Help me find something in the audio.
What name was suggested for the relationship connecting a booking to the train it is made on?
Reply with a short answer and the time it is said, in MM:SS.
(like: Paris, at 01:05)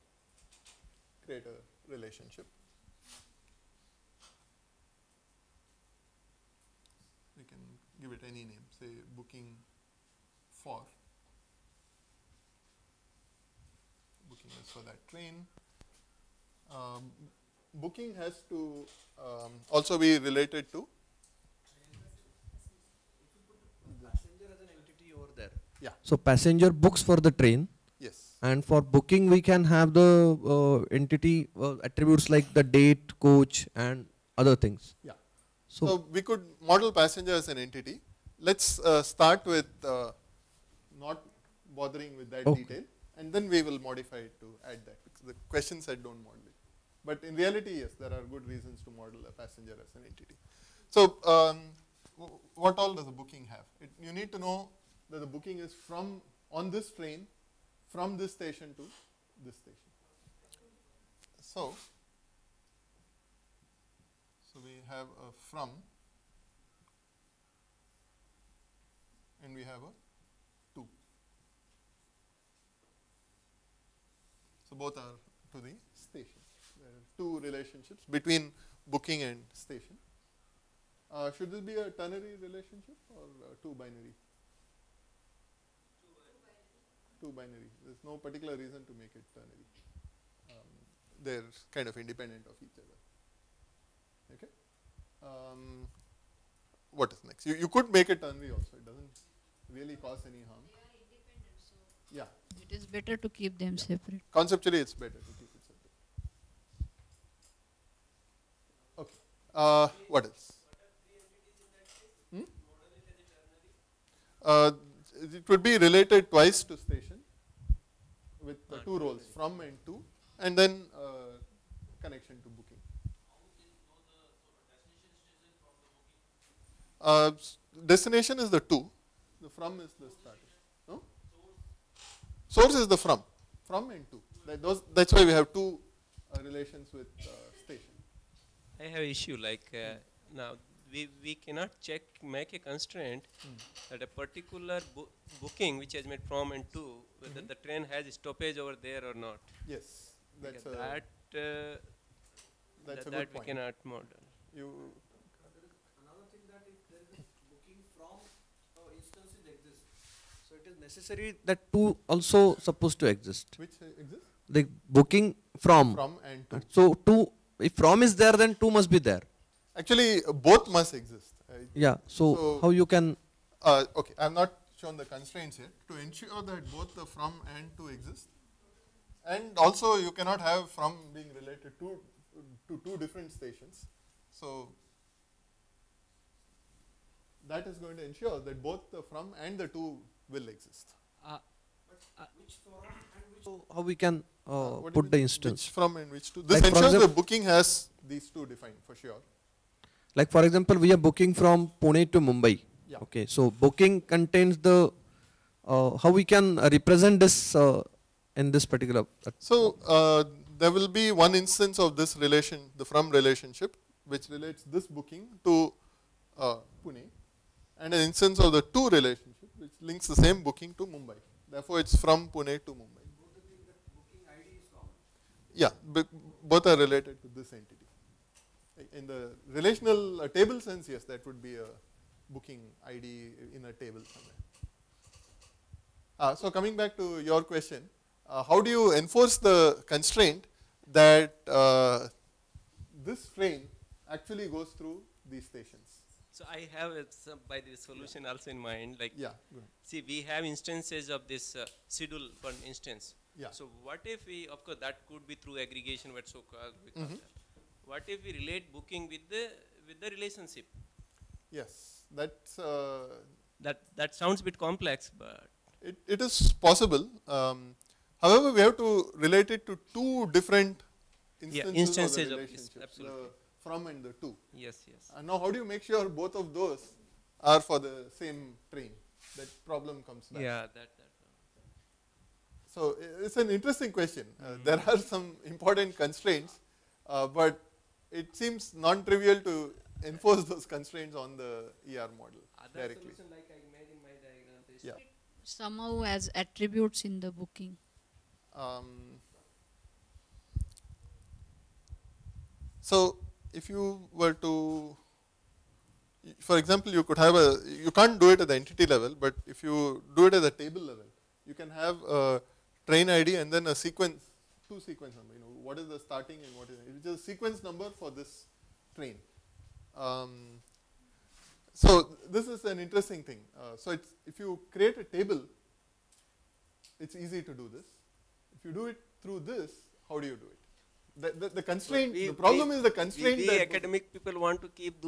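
booking for, at 00:09.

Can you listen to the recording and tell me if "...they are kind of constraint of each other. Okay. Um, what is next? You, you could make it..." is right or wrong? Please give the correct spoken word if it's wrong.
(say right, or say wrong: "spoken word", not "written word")
wrong: "independent", not "constraint".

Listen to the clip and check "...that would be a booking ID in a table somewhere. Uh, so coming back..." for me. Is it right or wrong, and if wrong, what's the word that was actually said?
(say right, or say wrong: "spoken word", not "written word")
right.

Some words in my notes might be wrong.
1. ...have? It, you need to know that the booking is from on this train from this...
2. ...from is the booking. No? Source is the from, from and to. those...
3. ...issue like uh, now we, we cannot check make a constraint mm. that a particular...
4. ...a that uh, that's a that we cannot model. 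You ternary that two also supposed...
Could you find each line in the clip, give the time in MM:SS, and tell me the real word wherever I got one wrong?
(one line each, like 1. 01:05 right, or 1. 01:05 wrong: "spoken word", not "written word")
1. 00:53 right
2. 02:09 wrong: "starting", not "booking"
3. 02:19 right
4. 02:30 wrong: "necessary", not "ternary".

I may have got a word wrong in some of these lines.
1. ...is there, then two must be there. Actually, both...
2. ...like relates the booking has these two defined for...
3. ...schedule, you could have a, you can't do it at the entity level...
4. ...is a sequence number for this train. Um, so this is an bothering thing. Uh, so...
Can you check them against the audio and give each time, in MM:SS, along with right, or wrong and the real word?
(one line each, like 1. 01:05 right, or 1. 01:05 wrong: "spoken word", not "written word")
1. 02:48 right
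2. 03:16 wrong: "ensures", not "relates"
3. 05:06 wrong: "example", not "schedule"
4. 05:17 wrong: "interesting", not "bothering".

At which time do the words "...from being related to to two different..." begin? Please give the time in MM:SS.
03:00.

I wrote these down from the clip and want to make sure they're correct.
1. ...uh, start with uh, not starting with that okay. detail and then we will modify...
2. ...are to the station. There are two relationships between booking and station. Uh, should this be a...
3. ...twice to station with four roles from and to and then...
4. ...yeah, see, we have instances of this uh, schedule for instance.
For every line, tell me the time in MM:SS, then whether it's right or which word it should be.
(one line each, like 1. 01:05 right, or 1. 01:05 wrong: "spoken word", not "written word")
1. 00:38 wrong: "bothering", not "starting"
2. 01:14 right
3. 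01:56 wrong: "two", not "four"
4. 04:09 right.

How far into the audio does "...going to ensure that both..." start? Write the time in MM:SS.
03:07.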